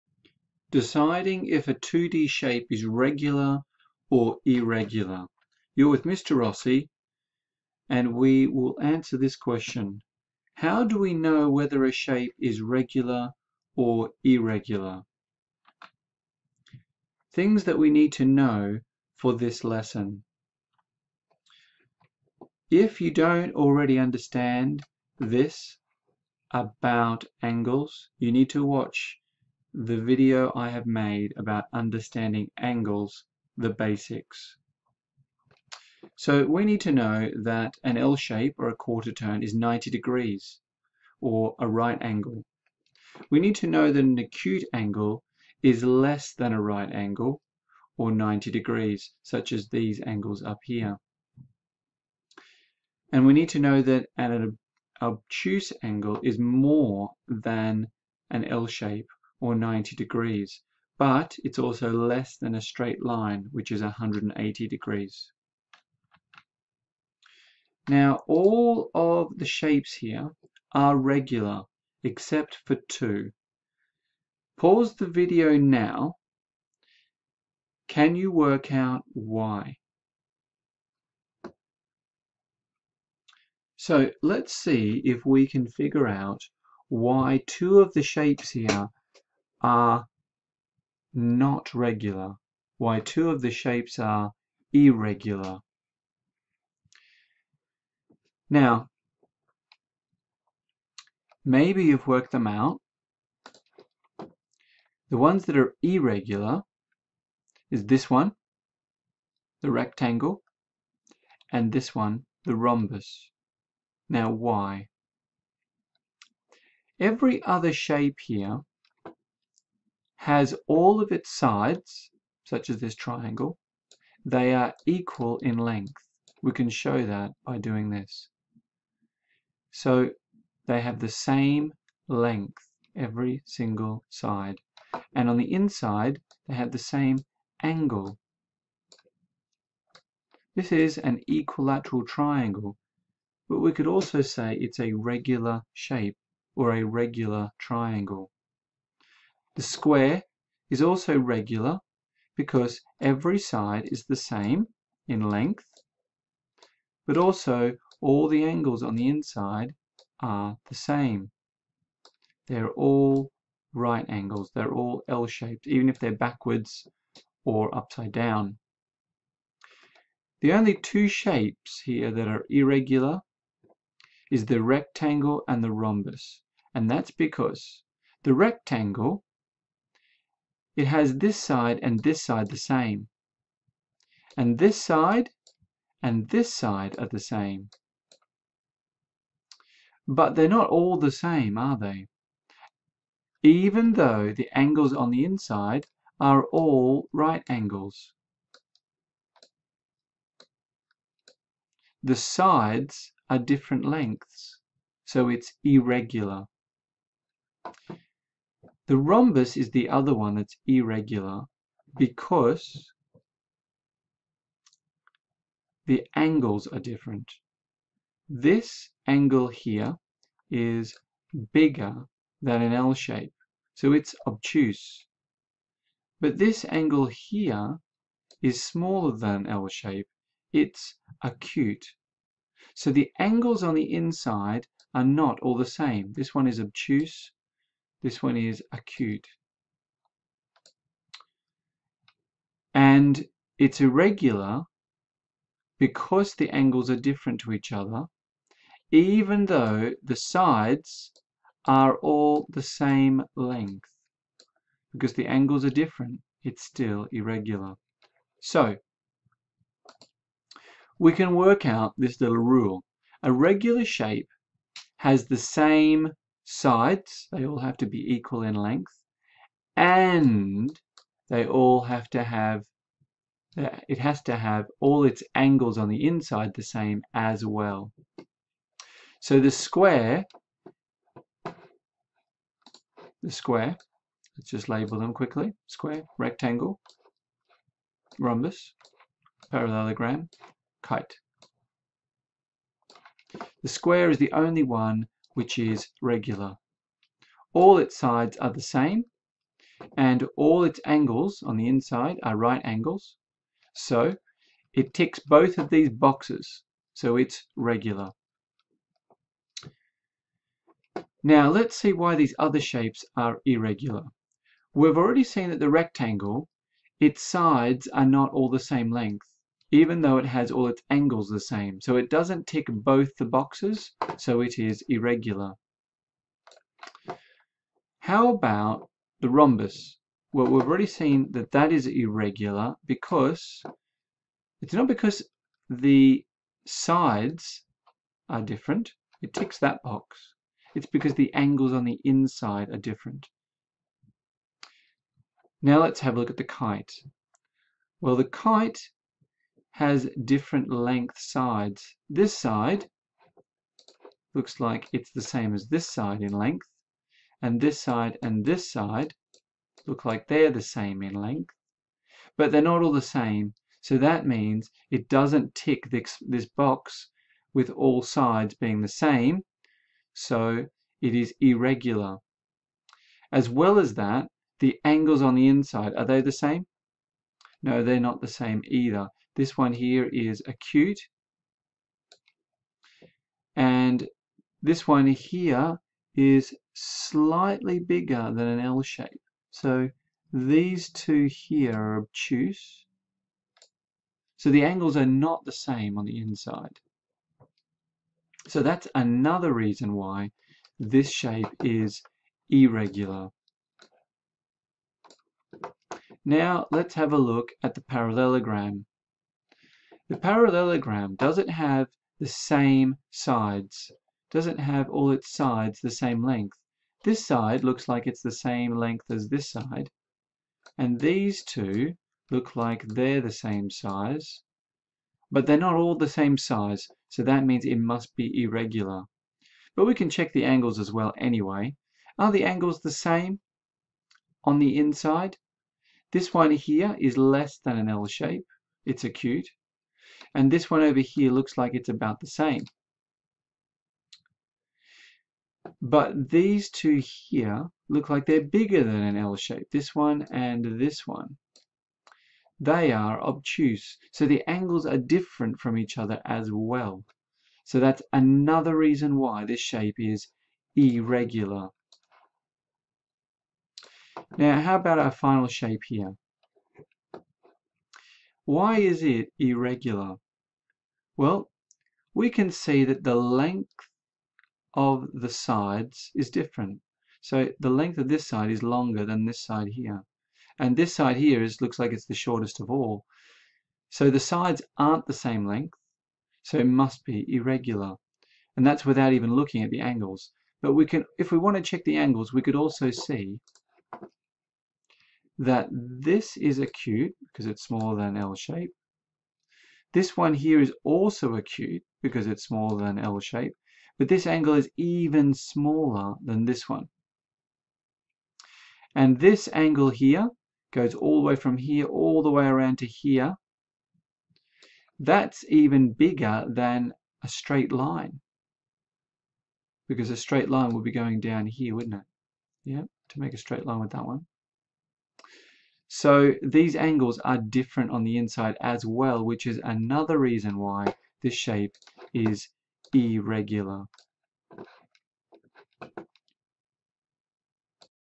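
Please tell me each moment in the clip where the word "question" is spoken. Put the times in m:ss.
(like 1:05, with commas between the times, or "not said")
0:09.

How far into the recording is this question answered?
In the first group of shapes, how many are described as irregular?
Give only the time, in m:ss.
1:12.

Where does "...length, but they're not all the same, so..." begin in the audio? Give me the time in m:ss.
6:01.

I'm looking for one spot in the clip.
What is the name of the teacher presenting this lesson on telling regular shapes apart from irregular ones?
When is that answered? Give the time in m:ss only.
0:06.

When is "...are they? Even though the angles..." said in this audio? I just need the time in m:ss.
3:11.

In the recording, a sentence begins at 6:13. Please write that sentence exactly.
As well as that, the angles on the inside, are they the same?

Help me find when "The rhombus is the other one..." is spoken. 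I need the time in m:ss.
3:28.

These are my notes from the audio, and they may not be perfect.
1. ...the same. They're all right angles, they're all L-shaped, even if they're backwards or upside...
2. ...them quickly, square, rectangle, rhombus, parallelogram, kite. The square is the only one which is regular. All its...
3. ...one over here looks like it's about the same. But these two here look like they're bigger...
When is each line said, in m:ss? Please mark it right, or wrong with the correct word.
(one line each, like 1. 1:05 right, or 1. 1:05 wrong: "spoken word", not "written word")
1. 2:40 right
2. 4:44 right
3. 7:20 right.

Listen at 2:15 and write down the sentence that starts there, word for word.
And on the inside, they have the same angle.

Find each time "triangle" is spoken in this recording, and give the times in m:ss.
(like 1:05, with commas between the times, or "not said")
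2:02, 2:22, 2:27.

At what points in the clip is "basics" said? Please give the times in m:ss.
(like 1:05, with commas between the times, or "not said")
0:33.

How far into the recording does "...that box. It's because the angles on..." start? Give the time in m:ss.
5:39.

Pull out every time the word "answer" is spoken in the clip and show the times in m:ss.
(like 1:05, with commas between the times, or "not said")
0:08.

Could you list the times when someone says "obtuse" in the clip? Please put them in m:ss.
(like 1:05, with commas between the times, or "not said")
0:55, 3:44, 3:56, 6:31, 7:33.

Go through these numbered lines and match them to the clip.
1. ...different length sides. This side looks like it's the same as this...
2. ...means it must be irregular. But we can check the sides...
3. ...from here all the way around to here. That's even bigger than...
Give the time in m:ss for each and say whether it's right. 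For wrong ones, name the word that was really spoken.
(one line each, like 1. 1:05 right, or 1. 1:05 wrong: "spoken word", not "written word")
1. 5:50 right
2. 7:07 wrong: "angles", not "sides"
3. 8:31 right.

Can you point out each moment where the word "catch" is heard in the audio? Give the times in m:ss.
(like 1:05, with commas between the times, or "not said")
not said.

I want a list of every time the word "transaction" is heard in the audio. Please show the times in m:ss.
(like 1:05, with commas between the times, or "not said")
not said.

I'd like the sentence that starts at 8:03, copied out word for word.
So the sides aren't the same length, so it must be irregular.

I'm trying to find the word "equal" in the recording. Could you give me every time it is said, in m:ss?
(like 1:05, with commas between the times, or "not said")
2:04, 4:28.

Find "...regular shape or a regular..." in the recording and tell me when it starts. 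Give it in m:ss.
2:24.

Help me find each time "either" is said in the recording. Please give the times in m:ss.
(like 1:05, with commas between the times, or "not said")
6:18.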